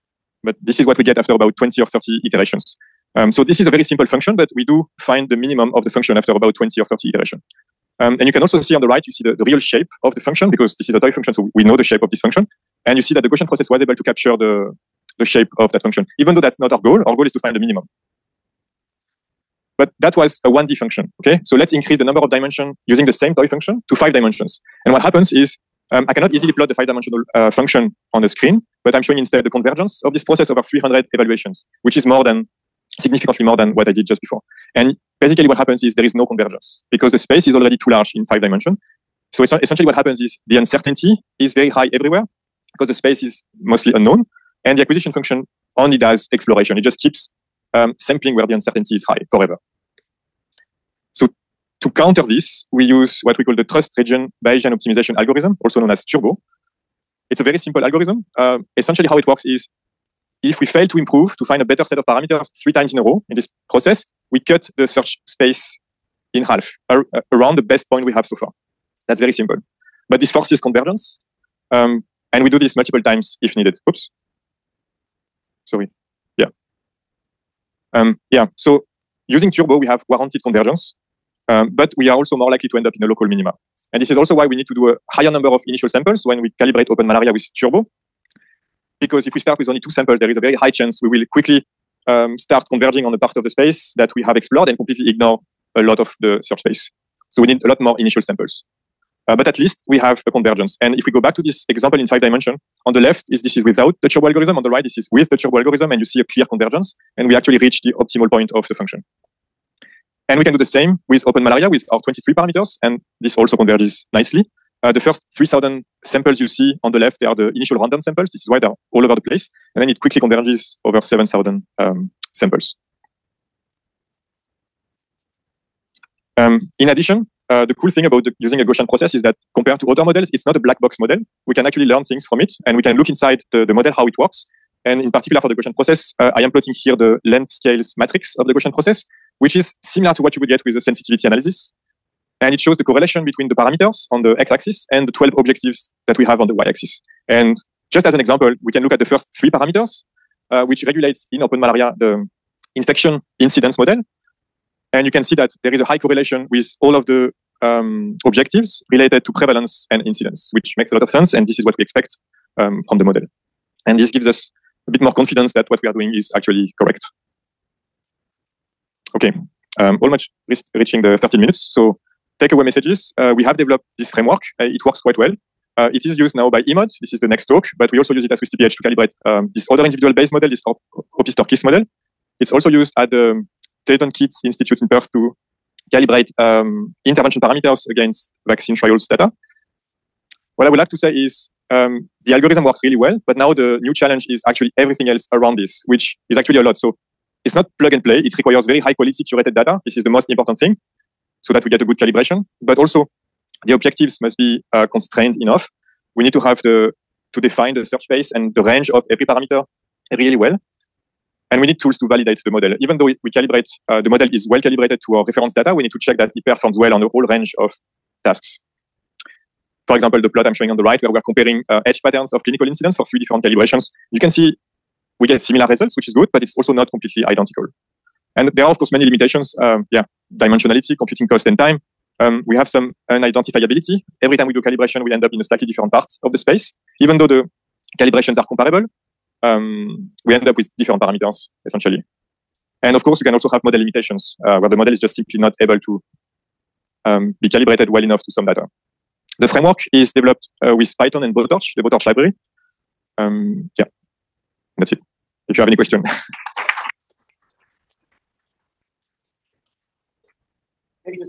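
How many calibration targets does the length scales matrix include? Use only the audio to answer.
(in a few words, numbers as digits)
12.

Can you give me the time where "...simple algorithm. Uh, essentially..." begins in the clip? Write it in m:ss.
0:57.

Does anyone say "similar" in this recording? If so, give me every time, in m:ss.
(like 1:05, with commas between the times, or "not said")
2:19, 3:45.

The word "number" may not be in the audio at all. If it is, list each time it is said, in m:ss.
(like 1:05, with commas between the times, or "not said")
0:22, 1:25.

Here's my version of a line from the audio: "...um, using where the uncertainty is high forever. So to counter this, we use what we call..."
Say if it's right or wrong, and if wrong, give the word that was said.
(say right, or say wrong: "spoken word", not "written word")
wrong: "sampling", not "using".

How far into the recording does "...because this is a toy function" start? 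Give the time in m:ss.
0:10.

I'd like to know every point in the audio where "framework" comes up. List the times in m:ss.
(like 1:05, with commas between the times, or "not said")
2:54, 4:09.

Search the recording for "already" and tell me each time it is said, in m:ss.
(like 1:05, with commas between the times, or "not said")
0:37.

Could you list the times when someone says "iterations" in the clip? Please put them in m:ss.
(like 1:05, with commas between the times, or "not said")
0:02, 0:07.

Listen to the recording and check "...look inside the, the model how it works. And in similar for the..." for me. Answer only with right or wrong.
wrong.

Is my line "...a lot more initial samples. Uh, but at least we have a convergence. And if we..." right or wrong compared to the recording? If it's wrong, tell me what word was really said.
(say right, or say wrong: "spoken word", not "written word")
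right.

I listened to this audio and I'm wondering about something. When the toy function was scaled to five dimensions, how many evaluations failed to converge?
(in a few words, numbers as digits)
300.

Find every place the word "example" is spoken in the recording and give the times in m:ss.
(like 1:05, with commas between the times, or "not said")
1:41, 2:28, 3:39.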